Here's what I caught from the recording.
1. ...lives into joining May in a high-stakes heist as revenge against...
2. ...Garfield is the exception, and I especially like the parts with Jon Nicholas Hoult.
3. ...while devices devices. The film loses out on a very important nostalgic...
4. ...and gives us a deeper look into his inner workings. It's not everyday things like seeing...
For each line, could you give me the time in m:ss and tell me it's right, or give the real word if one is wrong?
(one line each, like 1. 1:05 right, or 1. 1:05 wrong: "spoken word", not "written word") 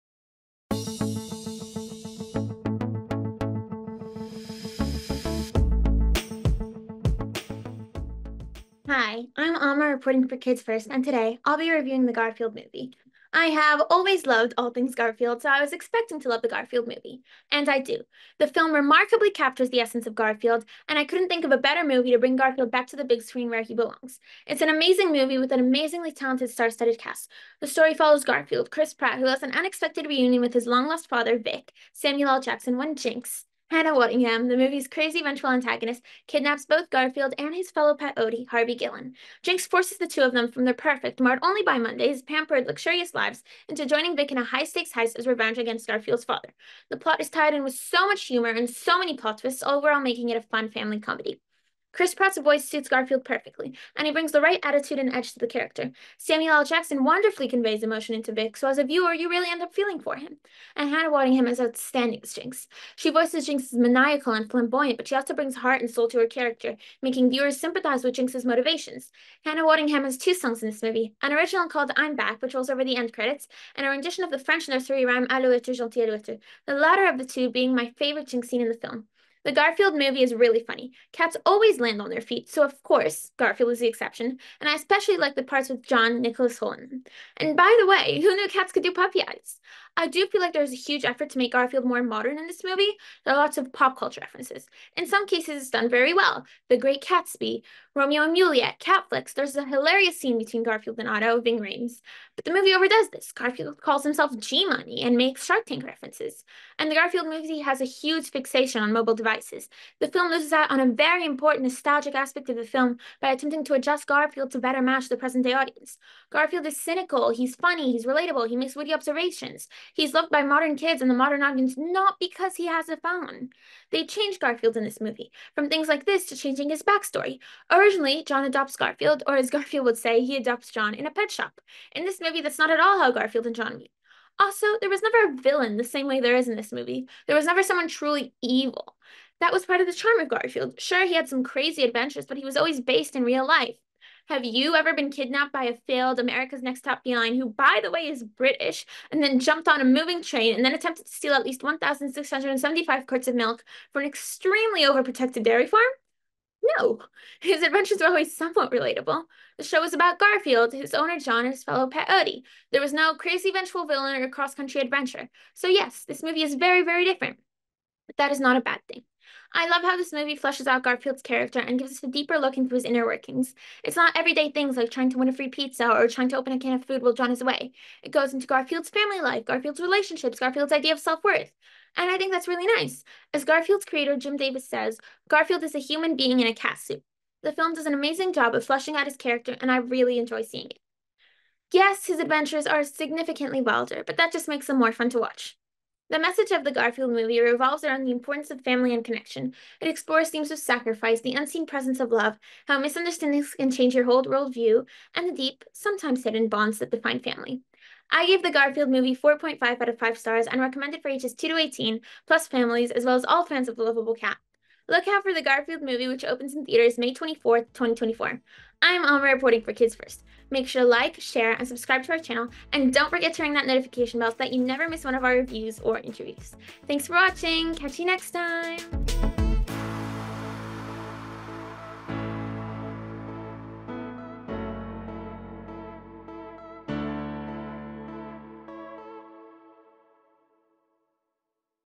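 1. 0:43 wrong: "Vic", not "May"
2. 1:23 right
3. 1:48 wrong: "mobile", not "while"
4. 2:51 wrong: "trying", not "seeing".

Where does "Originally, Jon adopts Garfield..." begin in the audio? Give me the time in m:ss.
2:07.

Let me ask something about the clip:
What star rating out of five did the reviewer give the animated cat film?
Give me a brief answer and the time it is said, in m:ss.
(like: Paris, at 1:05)
4.5, at 3:29.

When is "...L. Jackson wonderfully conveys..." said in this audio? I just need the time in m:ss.
0:56.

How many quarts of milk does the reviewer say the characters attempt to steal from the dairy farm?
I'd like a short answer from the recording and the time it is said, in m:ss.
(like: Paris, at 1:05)
1,675, at 2:31.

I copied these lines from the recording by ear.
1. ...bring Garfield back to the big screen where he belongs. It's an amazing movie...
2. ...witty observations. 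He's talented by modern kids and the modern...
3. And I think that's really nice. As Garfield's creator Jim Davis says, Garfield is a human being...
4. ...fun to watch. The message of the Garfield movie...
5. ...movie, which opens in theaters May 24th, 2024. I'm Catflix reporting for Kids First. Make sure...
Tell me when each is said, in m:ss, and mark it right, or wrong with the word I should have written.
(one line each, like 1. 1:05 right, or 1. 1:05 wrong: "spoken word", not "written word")
1. 0:22 right
2. 1:58 wrong: "loved", not "talented"
3. 3:01 right
4. 3:14 right
5. 3:35 wrong: "Alma", not "Catflix".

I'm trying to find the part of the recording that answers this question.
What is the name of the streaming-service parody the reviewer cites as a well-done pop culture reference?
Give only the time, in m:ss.
1:38.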